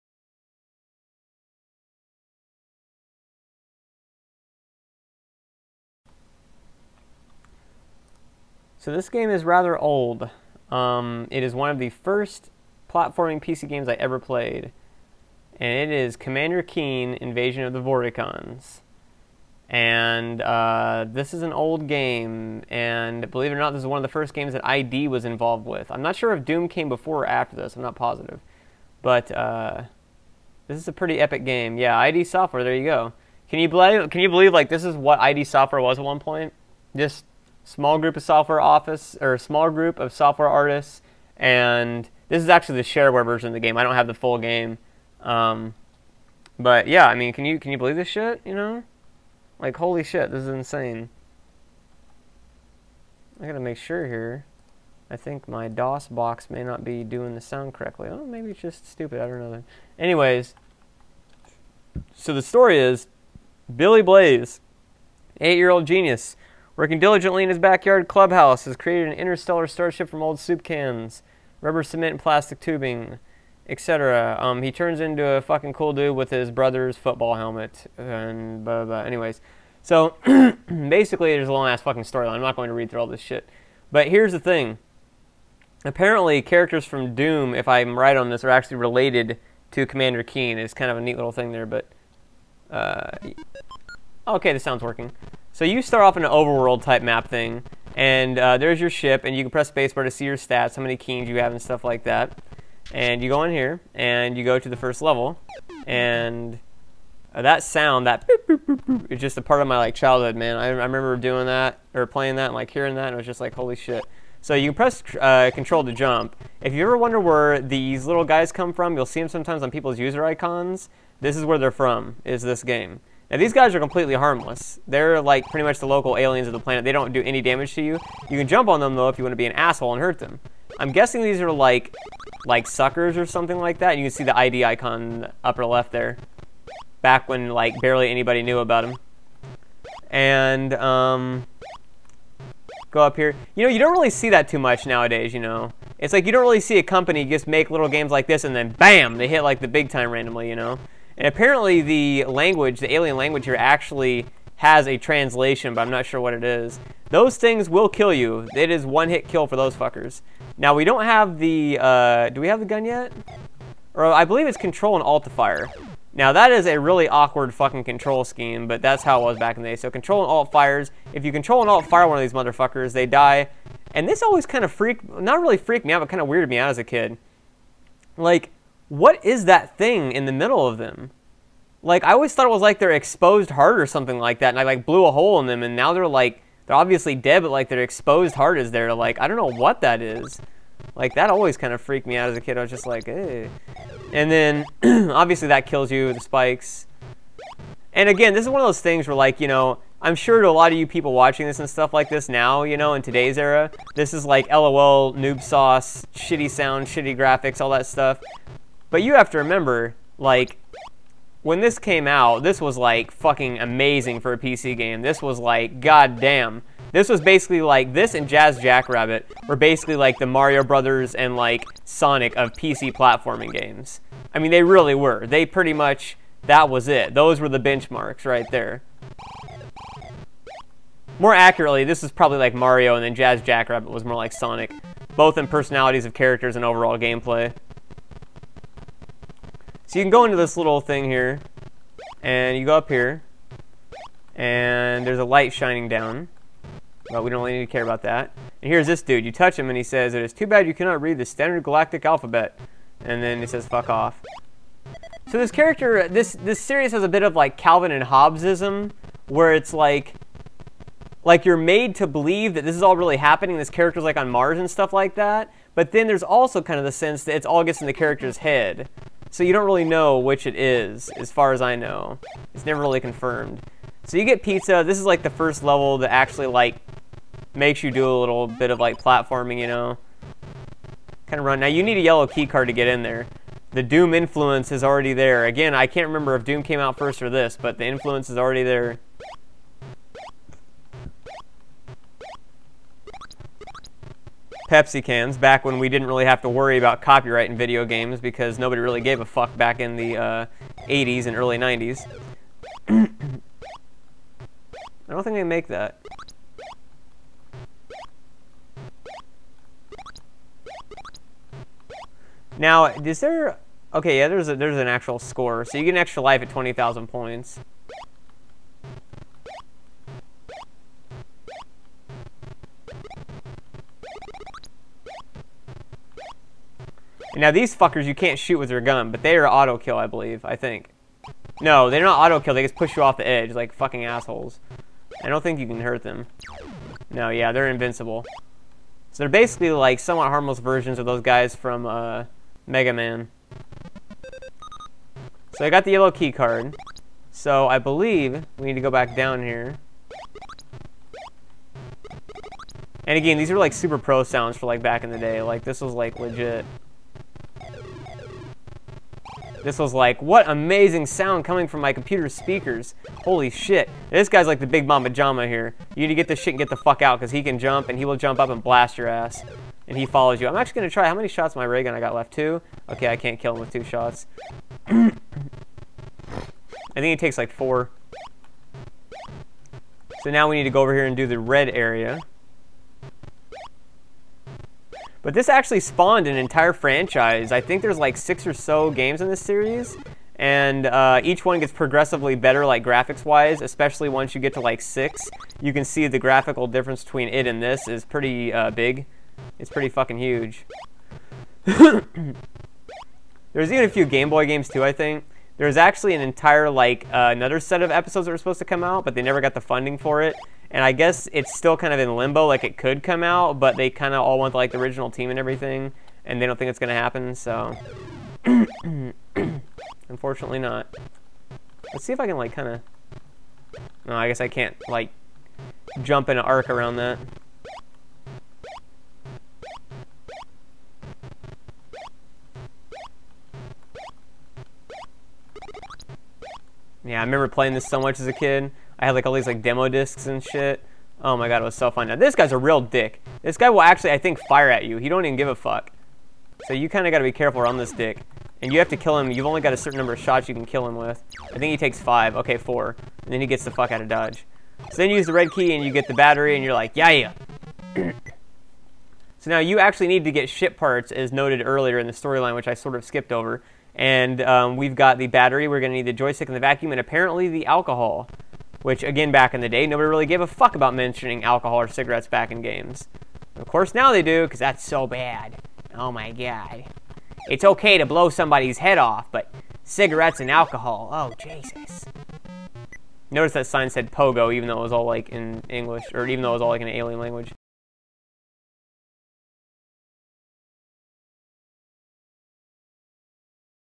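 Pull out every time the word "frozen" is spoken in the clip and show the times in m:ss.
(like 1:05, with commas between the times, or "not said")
not said.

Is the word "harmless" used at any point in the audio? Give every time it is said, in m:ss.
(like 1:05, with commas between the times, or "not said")
2:04, 5:40.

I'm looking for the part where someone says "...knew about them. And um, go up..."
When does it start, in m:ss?
2:18.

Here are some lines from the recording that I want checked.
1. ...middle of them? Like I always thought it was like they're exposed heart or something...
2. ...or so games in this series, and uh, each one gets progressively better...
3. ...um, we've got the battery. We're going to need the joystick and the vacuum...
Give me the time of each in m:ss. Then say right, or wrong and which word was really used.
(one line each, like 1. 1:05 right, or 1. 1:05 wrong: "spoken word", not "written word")
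1. 3:00 right
2. 6:28 right
3. 7:44 right.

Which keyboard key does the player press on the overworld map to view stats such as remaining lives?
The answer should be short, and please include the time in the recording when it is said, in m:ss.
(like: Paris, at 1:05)
Spacebar, at 1:39.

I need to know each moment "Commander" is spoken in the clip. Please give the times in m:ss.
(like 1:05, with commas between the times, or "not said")
0:16, 1:29.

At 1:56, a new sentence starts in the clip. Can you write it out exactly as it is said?
If you ever wonder where these little guys come from, you'll see them sometimes on people's user icons.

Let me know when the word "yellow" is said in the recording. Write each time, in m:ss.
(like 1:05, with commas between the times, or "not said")
4:42, 5:45.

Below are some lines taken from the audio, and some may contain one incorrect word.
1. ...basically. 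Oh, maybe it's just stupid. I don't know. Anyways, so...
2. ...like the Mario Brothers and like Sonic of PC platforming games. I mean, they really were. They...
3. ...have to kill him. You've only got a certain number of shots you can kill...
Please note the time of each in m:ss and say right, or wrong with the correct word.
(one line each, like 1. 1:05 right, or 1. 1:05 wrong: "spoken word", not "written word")
1. 0:57 wrong: "correctly", not "basically"
2. 3:39 right
3. 7:28 right.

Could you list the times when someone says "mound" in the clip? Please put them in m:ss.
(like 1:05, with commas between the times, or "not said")
not said.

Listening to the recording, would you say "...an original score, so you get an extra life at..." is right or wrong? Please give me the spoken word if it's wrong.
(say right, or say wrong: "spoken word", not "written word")
wrong: "actual", not "original".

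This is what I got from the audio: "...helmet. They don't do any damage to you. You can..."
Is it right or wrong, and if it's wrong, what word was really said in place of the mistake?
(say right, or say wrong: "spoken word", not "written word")
wrong: "planet", not "helmet".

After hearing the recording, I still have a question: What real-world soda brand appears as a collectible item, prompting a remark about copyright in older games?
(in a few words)
Pepsi.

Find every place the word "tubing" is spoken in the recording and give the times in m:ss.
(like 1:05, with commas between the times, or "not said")
1:12.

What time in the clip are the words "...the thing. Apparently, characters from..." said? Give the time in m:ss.
1:24.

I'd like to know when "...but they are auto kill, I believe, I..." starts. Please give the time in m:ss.
5:29.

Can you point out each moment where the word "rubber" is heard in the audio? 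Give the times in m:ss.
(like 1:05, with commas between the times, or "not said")
1:11.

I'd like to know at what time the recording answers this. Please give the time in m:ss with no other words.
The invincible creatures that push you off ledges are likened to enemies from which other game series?
5:42.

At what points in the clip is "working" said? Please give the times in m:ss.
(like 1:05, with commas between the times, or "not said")
1:06, 1:34.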